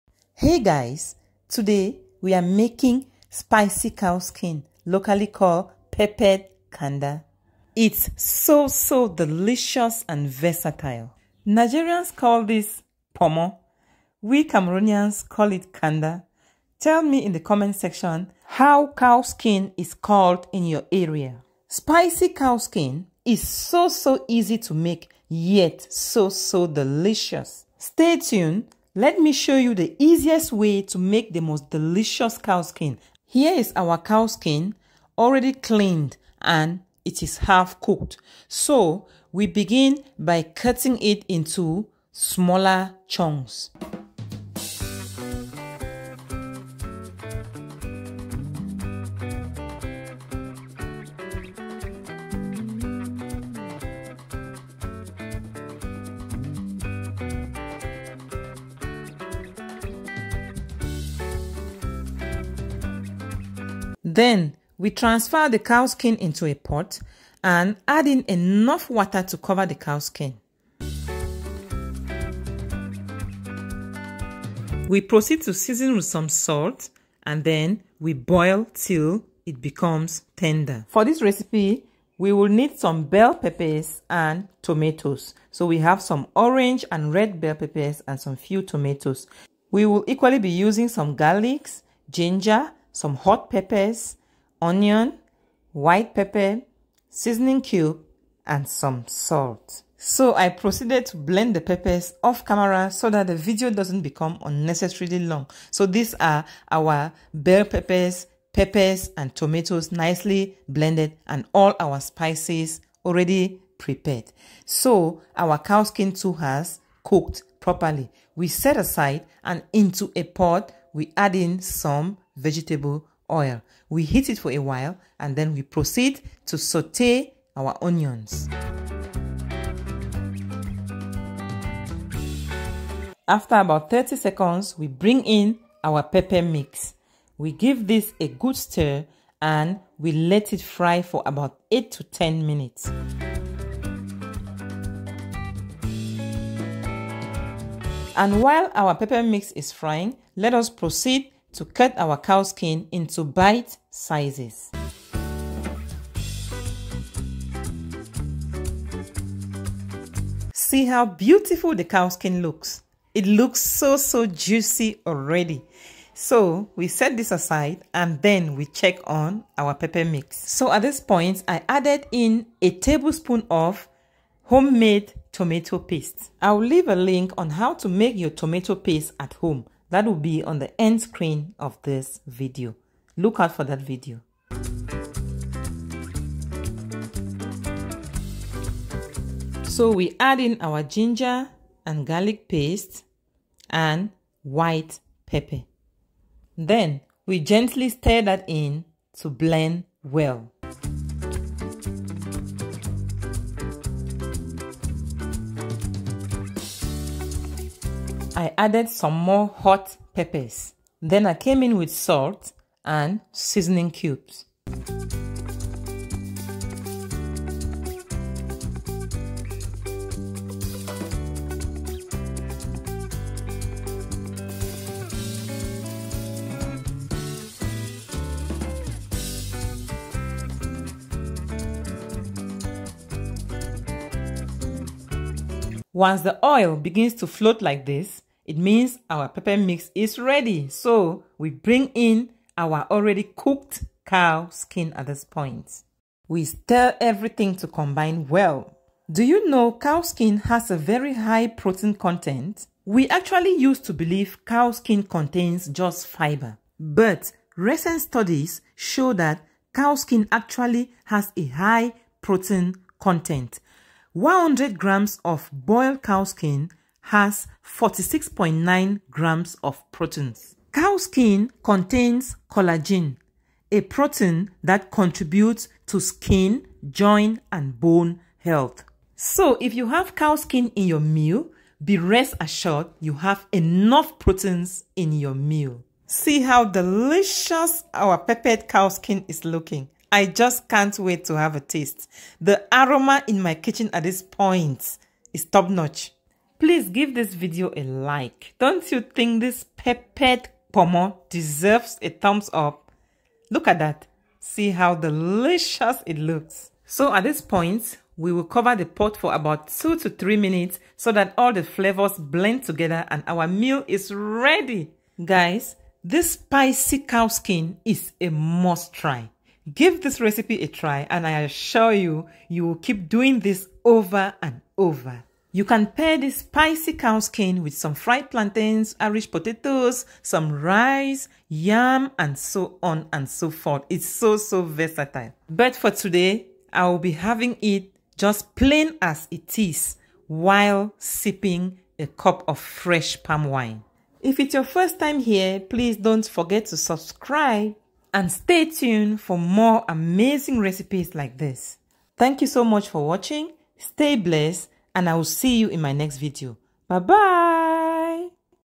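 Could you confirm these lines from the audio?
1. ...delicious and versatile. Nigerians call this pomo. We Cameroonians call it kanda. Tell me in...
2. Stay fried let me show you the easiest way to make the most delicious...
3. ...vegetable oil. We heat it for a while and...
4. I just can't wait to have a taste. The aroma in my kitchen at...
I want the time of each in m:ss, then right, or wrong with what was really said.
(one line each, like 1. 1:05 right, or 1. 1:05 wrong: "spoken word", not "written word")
1. 0:09 right
2. 0:27 wrong: "tuned", not "fried"
3. 2:02 right
4. 4:50 right.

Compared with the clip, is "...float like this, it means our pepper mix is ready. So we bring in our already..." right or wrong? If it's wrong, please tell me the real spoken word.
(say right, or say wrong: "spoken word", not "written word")
right.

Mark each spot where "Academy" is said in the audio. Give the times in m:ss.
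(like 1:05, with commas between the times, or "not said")
not said.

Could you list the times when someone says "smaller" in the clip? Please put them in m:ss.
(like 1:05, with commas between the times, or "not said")
0:42.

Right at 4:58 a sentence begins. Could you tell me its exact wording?
Don't you think this peppered pomo deserves a thumbs up?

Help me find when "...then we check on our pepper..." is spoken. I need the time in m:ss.
2:48.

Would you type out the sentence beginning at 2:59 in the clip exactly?
That will be on the end screen of this video.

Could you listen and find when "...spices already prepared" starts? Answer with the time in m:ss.
1:52.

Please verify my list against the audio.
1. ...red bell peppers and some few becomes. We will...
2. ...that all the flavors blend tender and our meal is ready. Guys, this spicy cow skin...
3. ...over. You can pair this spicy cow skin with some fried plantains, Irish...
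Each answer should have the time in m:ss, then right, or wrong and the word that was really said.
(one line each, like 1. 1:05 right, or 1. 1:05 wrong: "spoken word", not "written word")
1. 1:27 wrong: "tomatoes", not "becomes"
2. 5:11 wrong: "together", not "tender"
3. 5:24 right.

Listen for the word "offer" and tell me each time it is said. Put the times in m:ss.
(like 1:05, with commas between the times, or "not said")
not said.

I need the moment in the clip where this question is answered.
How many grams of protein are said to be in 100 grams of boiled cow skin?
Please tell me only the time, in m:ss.
4:27.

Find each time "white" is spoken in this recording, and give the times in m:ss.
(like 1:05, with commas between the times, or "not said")
1:35, 3:14.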